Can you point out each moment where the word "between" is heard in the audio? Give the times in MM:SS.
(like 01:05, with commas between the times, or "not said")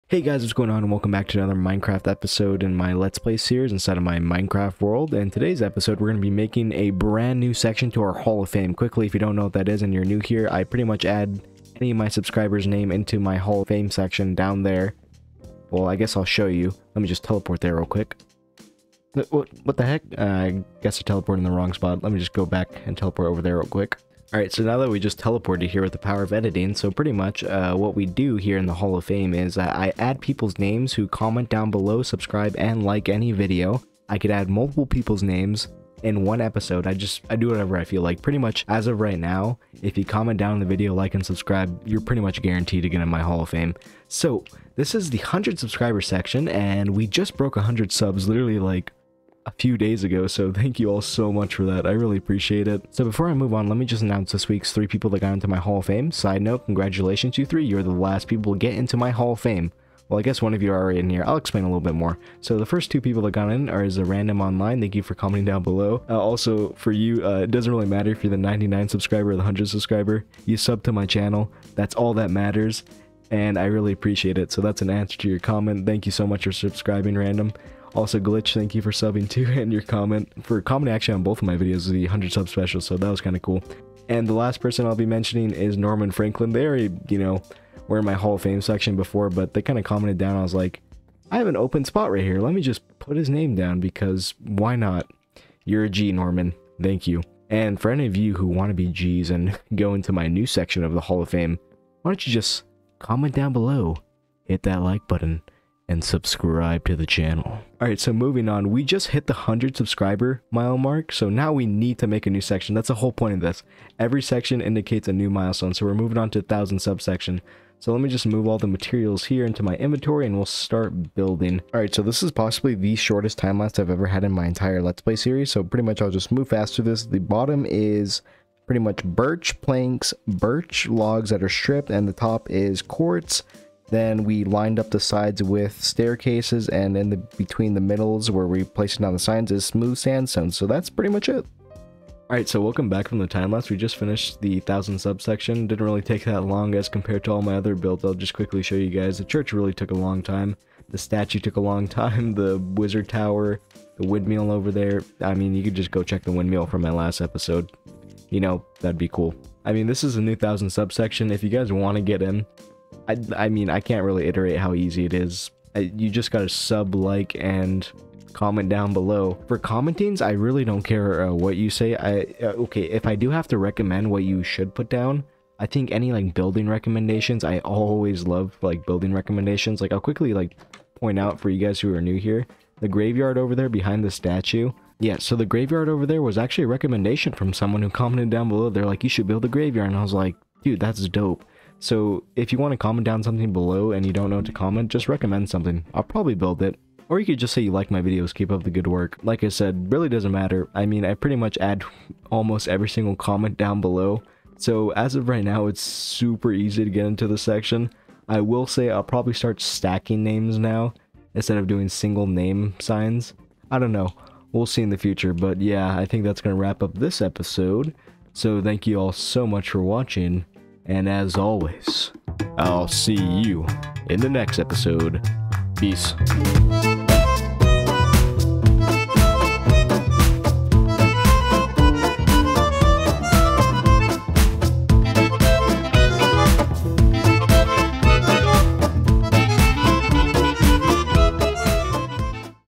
02:17.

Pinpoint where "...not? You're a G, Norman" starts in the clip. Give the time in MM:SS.
01:34.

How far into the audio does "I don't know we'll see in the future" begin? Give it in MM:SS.
03:33.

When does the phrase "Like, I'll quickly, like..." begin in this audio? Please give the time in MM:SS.
02:59.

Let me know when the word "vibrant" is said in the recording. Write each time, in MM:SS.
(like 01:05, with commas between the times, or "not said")
not said.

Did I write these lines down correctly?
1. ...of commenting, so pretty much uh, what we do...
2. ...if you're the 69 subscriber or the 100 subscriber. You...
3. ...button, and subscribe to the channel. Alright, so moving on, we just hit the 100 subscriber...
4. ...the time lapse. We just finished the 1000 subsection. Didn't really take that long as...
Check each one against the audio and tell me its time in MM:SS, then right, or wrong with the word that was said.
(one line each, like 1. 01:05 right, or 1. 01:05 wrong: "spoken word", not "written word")
1. 00:26 wrong: "editing", not "commenting"
2. 01:08 wrong: "99", not "69"
3. 01:45 right
4. 02:23 right.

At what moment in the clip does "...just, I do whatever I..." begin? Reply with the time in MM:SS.
00:36.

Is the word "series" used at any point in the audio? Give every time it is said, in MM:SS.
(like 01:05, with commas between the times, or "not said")
00:03, 02:05.